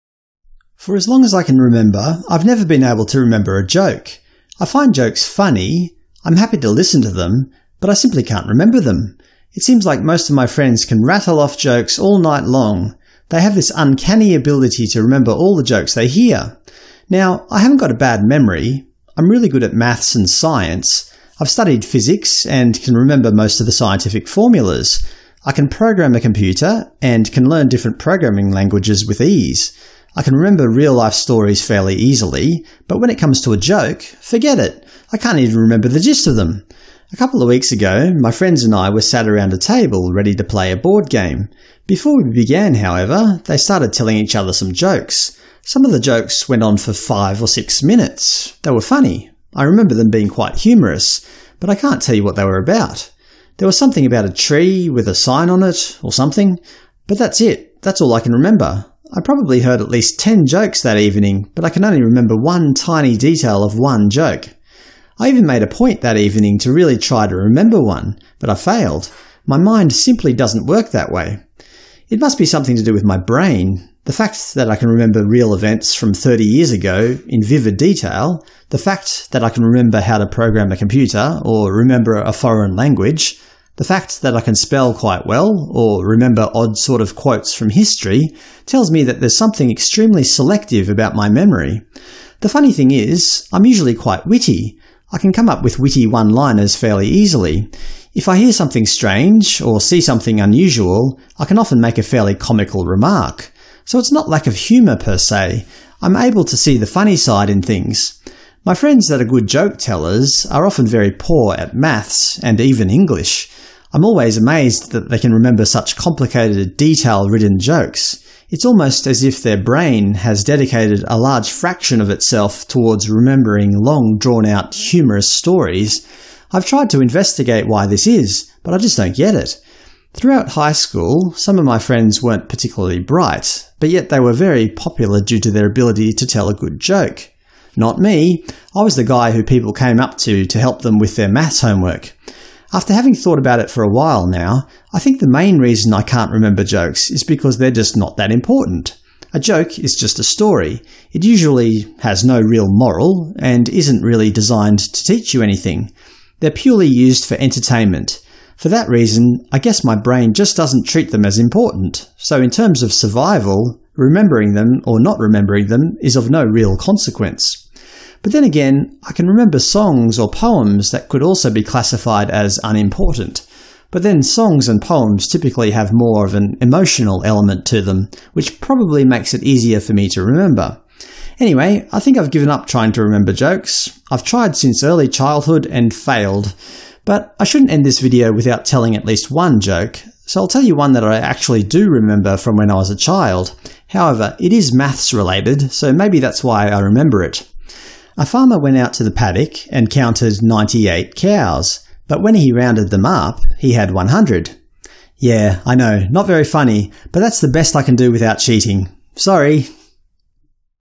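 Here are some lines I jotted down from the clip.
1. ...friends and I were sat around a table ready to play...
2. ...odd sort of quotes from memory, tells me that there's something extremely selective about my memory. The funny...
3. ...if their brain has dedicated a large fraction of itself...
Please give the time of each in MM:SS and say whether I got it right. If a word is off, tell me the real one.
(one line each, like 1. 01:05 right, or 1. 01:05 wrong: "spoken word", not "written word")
1. 00:38 right
2. 01:26 wrong: "history", not "memory"
3. 01:59 right.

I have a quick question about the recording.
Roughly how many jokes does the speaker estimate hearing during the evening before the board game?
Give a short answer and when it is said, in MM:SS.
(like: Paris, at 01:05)
10, at 01:00.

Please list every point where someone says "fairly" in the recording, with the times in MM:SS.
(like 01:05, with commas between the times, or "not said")
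00:31, 01:36, 01:42.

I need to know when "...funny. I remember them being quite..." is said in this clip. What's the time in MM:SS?
00:48.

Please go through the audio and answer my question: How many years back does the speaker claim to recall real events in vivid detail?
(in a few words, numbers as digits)
30.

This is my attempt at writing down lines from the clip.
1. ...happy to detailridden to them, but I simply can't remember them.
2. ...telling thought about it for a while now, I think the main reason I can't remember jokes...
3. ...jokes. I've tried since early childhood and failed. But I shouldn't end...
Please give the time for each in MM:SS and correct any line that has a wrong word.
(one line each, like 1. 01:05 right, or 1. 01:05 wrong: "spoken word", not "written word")
1. 00:06 wrong: "listen", not "detailridden"
2. 02:22 wrong: "having", not "telling"
3. 03:03 right.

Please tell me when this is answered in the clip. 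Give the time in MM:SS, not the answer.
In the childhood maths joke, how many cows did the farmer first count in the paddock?
03:20.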